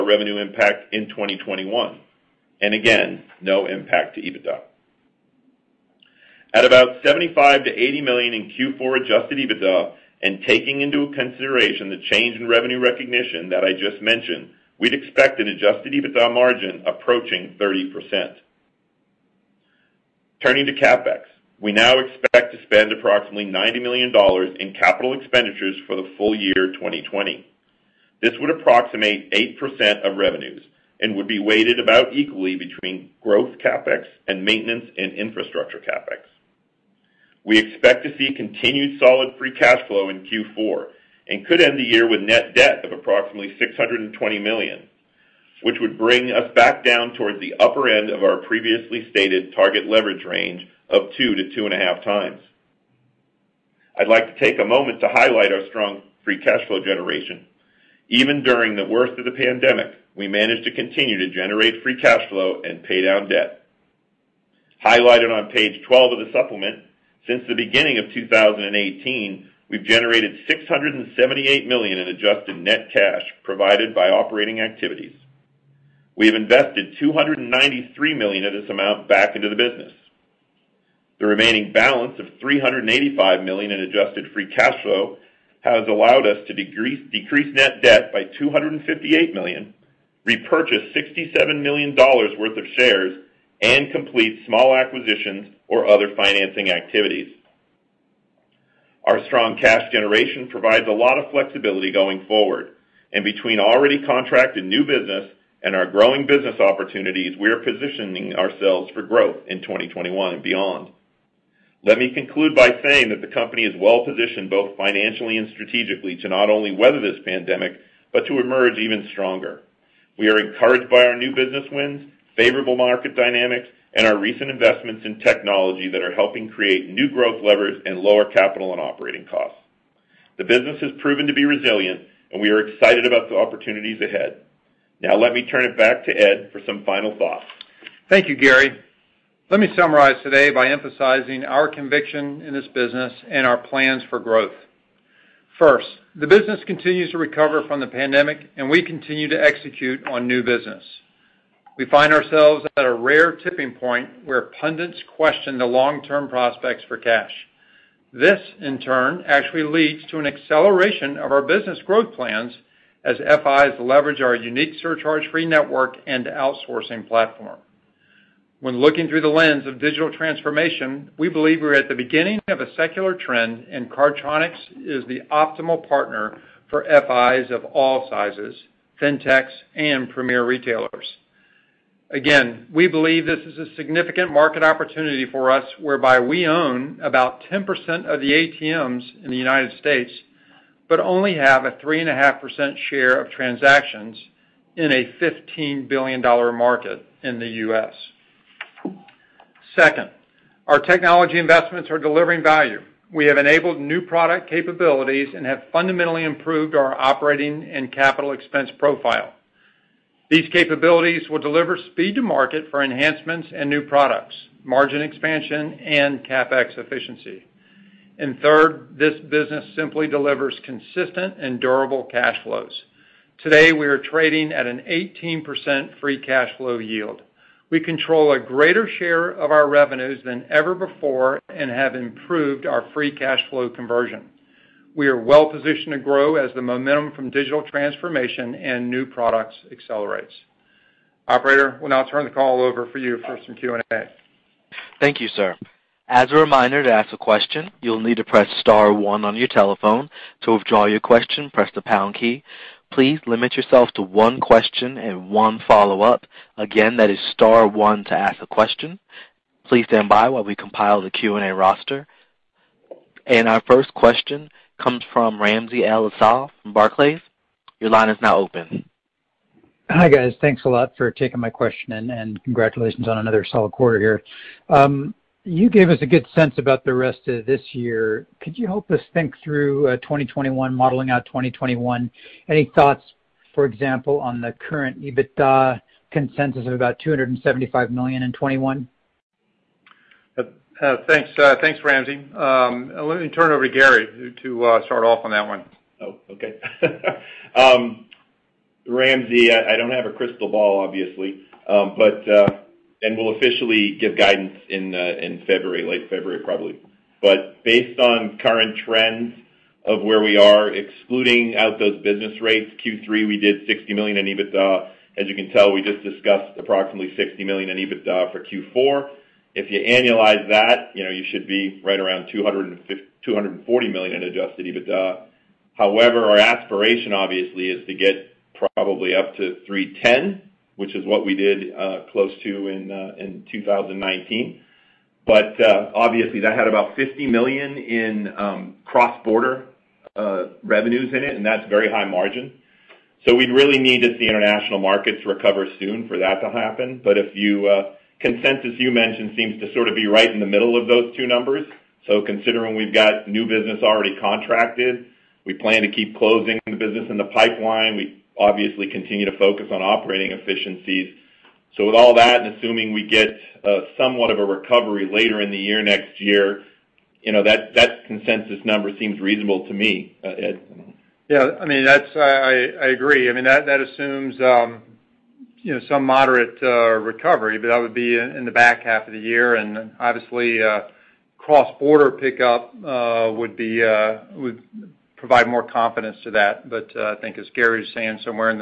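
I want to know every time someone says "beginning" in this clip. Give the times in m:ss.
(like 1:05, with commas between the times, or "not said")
1:07, 2:51.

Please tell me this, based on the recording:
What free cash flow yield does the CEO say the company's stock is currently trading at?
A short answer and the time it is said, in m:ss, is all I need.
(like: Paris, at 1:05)
18%, at 3:44.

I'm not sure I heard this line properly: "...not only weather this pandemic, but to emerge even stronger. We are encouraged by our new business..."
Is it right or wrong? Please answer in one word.
right.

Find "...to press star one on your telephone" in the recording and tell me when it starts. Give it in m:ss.
4:08.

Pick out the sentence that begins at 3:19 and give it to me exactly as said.
Second, our technology investments are delivering value.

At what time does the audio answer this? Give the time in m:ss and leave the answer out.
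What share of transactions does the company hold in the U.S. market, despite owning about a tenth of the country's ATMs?
3:11.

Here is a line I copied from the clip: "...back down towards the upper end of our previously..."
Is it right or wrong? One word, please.
right.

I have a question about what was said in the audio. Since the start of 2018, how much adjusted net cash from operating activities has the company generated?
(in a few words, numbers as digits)
$678 million.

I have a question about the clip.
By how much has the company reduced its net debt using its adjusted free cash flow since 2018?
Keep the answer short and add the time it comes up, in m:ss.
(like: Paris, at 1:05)
$258 million, at 1:28.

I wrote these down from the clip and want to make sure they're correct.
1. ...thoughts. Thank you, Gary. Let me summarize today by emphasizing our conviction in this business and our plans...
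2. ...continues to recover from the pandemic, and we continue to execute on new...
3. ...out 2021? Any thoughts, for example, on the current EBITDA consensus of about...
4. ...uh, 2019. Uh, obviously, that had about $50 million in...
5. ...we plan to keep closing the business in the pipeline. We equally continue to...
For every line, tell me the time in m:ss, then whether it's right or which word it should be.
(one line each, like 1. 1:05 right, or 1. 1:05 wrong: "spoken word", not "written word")
1. 2:17 right
2. 2:26 right
3. 4:41 right
4. 5:32 right
5. 5:55 wrong: "obviously", not "equally".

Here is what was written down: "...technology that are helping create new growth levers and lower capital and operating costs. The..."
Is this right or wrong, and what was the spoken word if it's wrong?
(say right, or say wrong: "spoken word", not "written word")
right.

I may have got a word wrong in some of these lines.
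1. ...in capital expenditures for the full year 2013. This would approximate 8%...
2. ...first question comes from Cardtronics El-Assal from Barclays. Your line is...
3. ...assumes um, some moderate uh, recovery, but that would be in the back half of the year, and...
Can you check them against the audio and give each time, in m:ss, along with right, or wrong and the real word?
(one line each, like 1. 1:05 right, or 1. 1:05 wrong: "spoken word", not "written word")
1. 0:24 wrong: "2020", not "2013"
2. 4:23 wrong: "Ramsey", not "Cardtronics"
3. 6:13 right.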